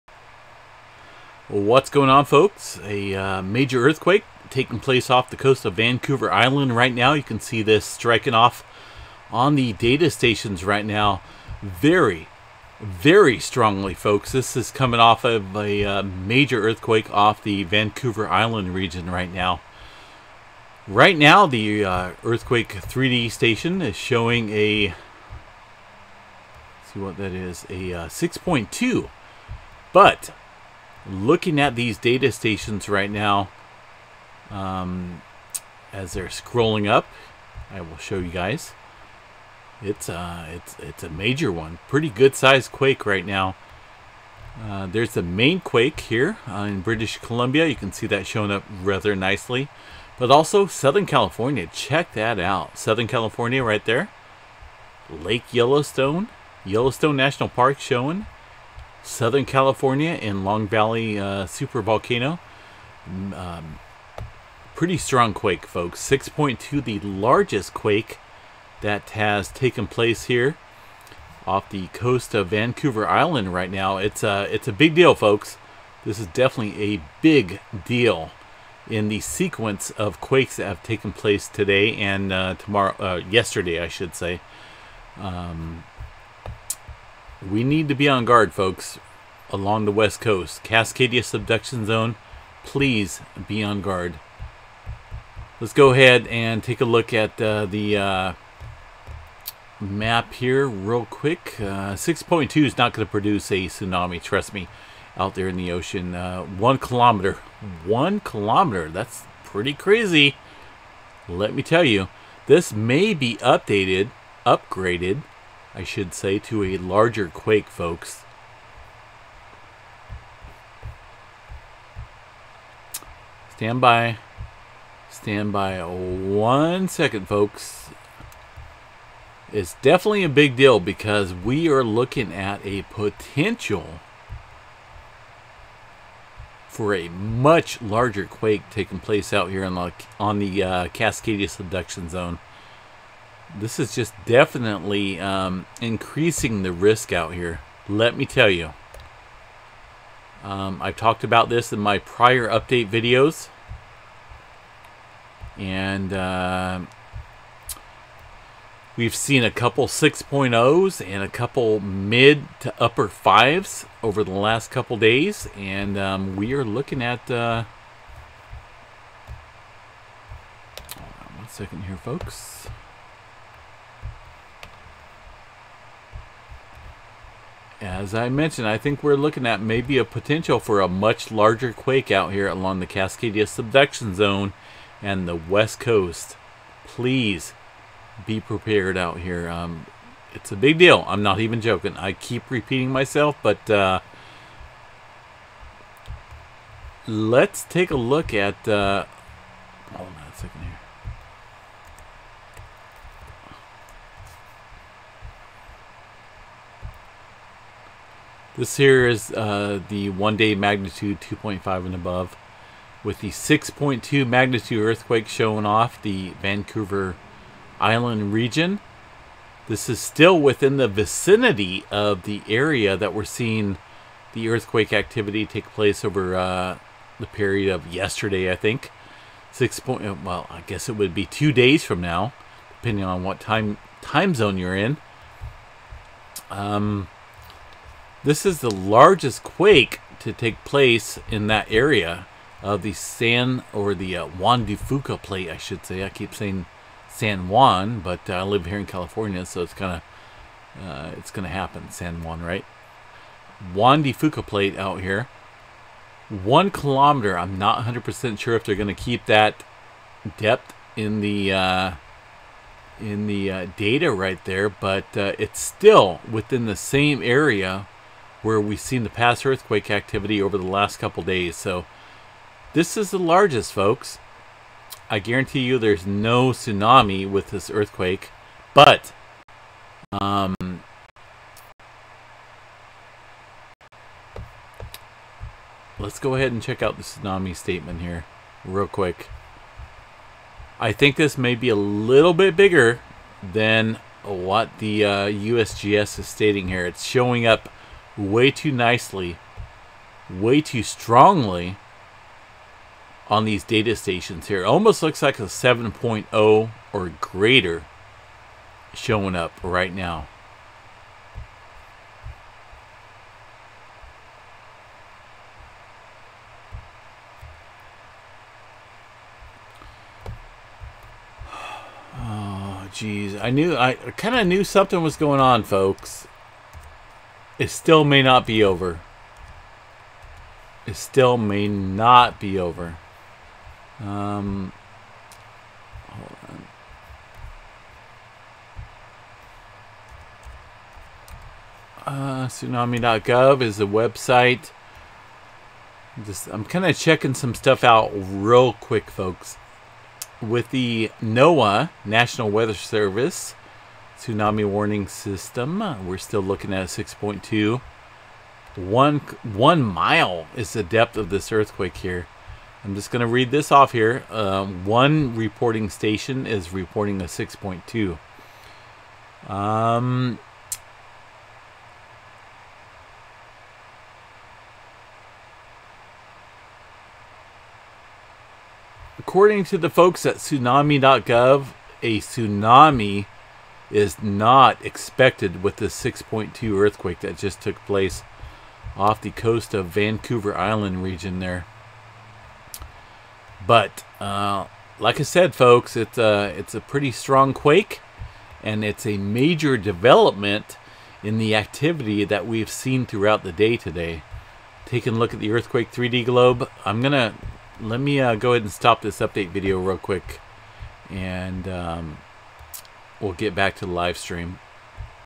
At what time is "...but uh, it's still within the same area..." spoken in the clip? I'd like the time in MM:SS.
04:24.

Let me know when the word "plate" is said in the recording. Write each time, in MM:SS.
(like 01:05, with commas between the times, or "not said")
04:05, 04:14.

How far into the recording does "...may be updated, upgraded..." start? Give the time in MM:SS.
01:52.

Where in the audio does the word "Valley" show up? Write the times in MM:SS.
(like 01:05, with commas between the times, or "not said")
01:00.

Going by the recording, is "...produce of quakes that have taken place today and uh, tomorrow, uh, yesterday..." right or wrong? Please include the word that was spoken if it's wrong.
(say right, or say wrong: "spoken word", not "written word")
wrong: "sequence", not "produce".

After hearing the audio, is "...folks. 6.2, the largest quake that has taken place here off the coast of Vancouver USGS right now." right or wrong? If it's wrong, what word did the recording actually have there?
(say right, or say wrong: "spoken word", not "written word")
wrong: "Island", not "USGS".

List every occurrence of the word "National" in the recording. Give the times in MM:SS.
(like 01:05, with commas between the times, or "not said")
00:57, 05:52.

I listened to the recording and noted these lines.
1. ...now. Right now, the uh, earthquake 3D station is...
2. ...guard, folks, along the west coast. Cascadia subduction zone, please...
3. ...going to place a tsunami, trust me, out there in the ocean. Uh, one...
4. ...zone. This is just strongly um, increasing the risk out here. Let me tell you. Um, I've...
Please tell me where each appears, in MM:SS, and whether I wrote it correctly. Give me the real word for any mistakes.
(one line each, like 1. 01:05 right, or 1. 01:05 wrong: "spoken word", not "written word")
1. 00:19 right
2. 01:28 right
3. 01:42 wrong: "produce", not "place"
4. 02:22 wrong: "definitely", not "strongly".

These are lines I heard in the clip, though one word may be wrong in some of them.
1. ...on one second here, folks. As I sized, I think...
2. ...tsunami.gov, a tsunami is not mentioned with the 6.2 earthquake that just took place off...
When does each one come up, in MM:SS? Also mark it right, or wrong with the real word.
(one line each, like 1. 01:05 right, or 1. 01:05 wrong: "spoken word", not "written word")
1. 02:50 wrong: "mentioned", not "sized"
2. 06:20 wrong: "expected", not "mentioned".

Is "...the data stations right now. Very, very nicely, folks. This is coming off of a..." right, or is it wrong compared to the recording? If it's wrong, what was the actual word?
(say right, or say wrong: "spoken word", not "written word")
wrong: "strongly", not "nicely".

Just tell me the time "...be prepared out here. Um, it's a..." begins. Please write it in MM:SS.
03:08.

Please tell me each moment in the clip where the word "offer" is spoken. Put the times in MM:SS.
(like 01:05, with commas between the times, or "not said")
not said.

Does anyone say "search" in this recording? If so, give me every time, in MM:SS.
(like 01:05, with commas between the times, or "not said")
not said.